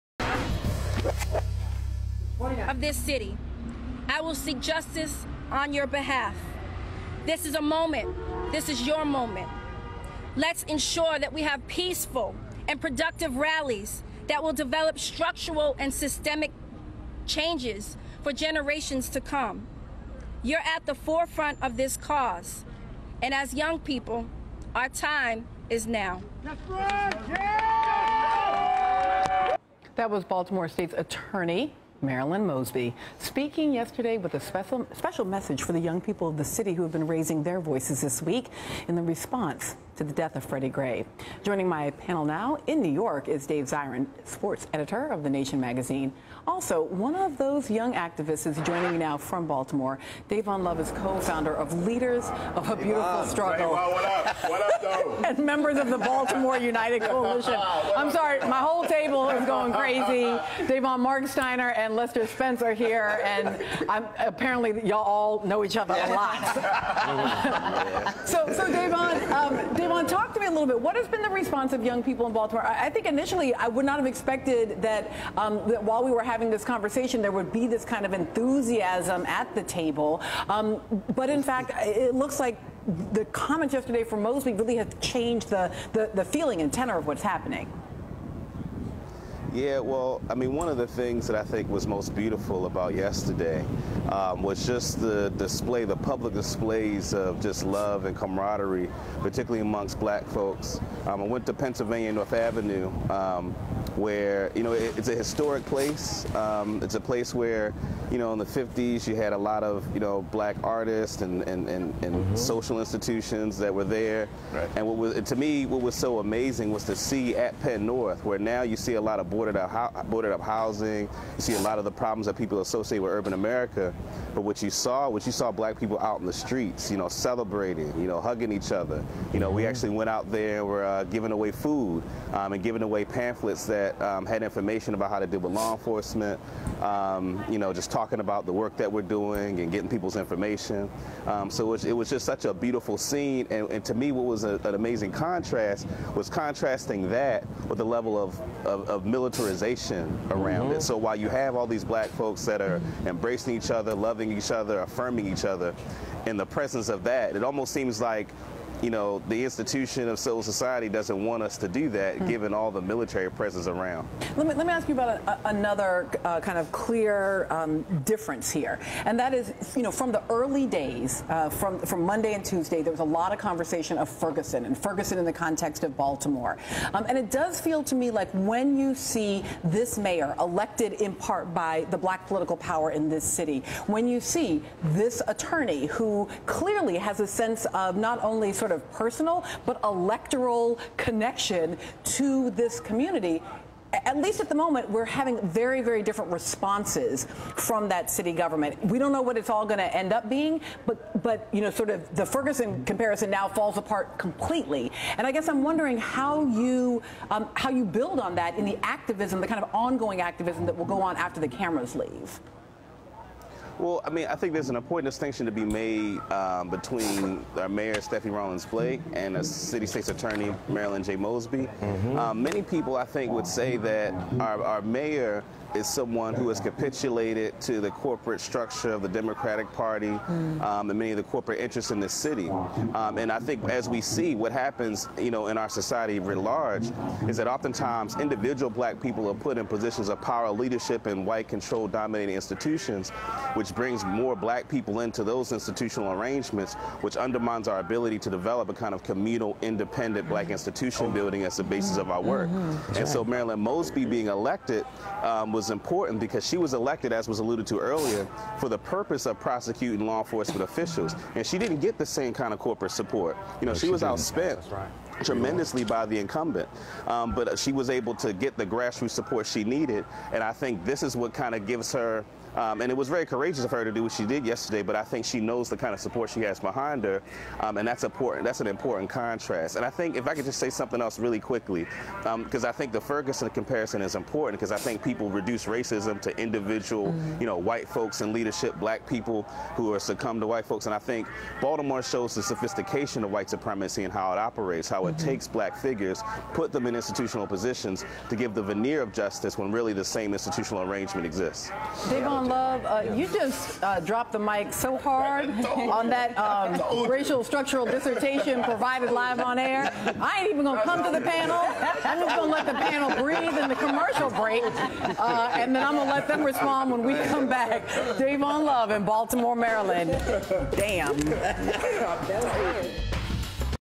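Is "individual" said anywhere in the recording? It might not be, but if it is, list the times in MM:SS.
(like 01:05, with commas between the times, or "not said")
03:58, 04:46.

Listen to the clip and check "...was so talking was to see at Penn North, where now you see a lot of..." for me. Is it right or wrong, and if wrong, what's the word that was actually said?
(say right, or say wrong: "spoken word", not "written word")
wrong: "amazing", not "talking".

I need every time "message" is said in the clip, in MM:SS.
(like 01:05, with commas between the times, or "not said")
00:35.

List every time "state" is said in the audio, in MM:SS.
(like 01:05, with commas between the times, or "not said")
00:30, 03:39.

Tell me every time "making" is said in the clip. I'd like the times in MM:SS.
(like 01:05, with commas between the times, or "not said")
not said.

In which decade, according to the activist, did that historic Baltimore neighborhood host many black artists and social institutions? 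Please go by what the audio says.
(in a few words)
the 1950s.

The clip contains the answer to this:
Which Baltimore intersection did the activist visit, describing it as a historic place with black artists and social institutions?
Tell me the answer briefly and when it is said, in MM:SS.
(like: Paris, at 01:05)
Pennsylvania North Avenue, at 01:41.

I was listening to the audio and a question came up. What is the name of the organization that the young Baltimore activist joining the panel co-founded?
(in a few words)
Leaders of a Beautiful Struggle.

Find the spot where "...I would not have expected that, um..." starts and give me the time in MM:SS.
01:13.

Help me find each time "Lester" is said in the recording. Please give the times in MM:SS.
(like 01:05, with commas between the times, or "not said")
01:01.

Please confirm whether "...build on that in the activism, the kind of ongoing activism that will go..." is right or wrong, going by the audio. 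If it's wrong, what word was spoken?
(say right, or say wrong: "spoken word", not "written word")
right.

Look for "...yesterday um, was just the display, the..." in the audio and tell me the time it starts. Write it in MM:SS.
01:32.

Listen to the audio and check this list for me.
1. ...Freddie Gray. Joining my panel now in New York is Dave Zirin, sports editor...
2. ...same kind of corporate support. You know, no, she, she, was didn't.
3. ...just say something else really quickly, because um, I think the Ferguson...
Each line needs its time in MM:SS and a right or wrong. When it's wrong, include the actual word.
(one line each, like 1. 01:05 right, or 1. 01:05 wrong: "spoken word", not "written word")
1. 00:40 right
2. 04:22 right
3. 04:40 right.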